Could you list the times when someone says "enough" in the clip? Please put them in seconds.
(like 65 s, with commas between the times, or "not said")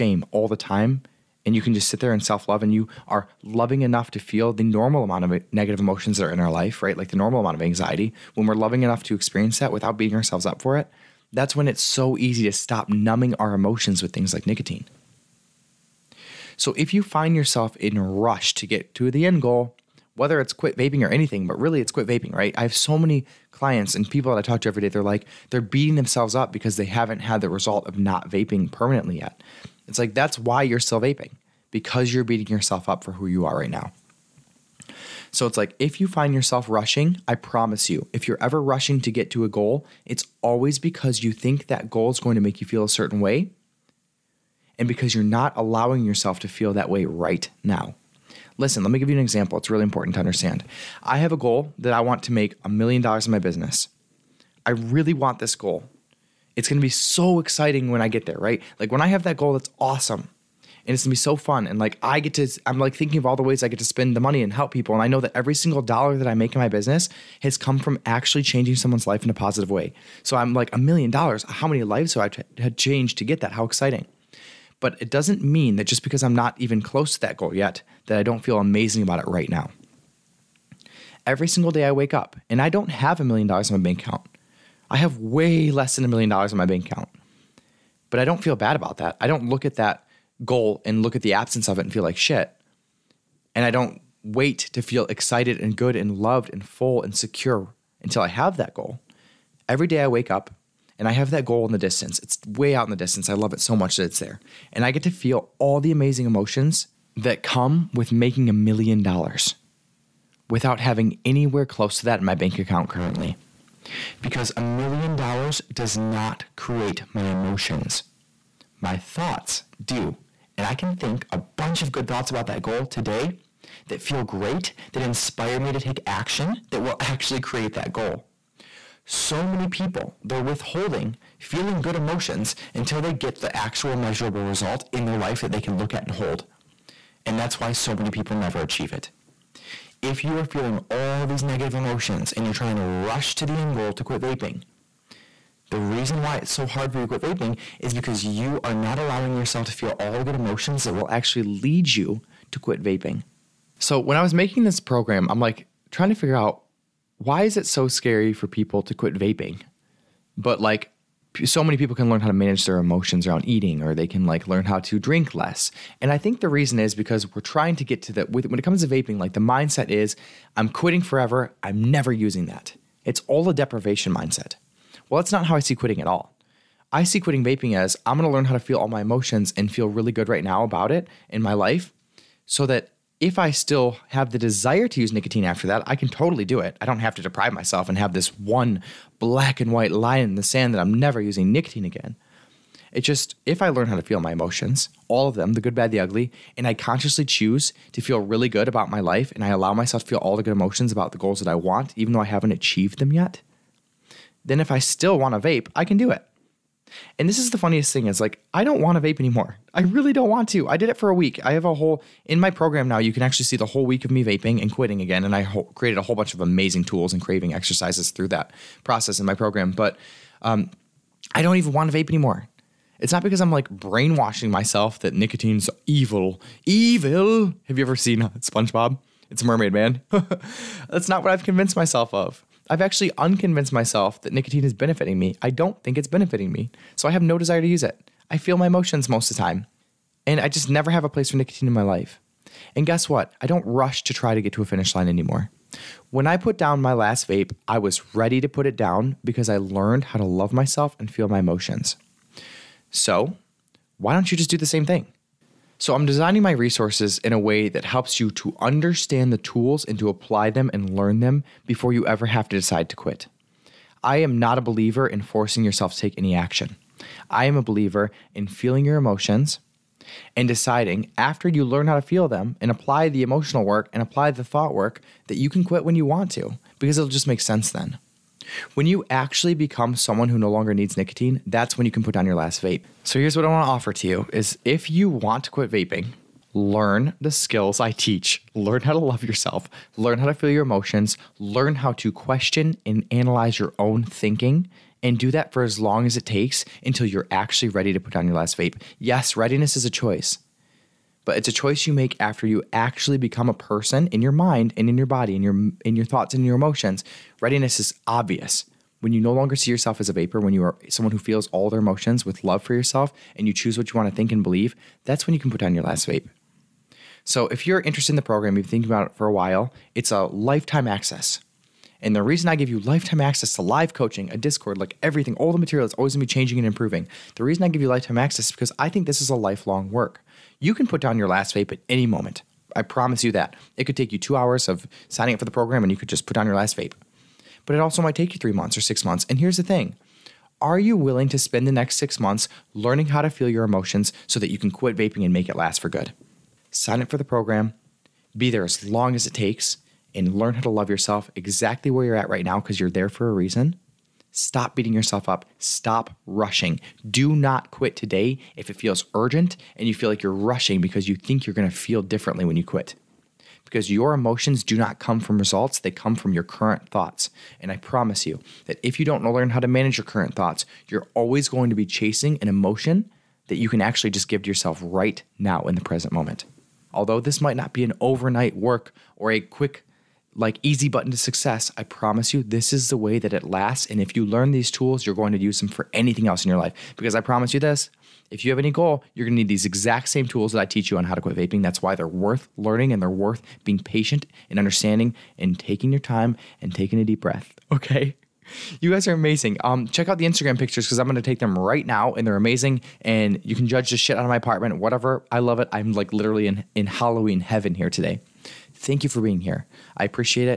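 3 s, 8 s.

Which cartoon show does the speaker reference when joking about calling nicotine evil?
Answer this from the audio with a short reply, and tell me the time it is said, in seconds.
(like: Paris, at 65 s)
SpongeBob, at 228 s.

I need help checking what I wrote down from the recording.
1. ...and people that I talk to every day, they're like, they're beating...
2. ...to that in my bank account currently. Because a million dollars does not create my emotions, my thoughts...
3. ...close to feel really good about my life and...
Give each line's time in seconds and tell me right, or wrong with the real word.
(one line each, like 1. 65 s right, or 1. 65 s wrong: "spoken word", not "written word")
1. 23 s right
2. 111 s right
3. 197 s wrong: "choose", not "close".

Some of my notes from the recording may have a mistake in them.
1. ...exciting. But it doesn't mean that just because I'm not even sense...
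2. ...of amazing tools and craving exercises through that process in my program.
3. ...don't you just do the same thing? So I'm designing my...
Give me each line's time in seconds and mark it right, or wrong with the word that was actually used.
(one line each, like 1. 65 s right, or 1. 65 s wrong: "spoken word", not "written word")
1. 73 s wrong: "close", not "sense"
2. 216 s right
3. 254 s right.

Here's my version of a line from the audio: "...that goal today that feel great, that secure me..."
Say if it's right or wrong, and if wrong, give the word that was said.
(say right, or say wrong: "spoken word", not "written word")
wrong: "inspire", not "secure".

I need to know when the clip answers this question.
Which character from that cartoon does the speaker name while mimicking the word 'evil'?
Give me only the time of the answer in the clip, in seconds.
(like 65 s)
229 s.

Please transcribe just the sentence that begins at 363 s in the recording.
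Because your emotions do not come from results, they come from your current thoughts.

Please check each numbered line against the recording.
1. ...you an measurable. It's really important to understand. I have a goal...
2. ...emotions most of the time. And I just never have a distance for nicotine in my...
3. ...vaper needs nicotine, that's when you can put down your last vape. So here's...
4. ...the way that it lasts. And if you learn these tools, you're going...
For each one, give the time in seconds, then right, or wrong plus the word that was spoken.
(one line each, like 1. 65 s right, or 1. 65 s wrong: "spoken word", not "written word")
1. 49 s wrong: "example", not "measurable"
2. 238 s wrong: "place", not "distance"
3. 280 s wrong: "longer", not "vaper"
4. 382 s right.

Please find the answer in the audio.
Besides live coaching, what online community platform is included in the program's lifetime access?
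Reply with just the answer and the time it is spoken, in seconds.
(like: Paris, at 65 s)
Discord, at 324 s.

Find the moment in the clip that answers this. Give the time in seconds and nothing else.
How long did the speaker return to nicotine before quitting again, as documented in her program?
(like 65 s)
211 s.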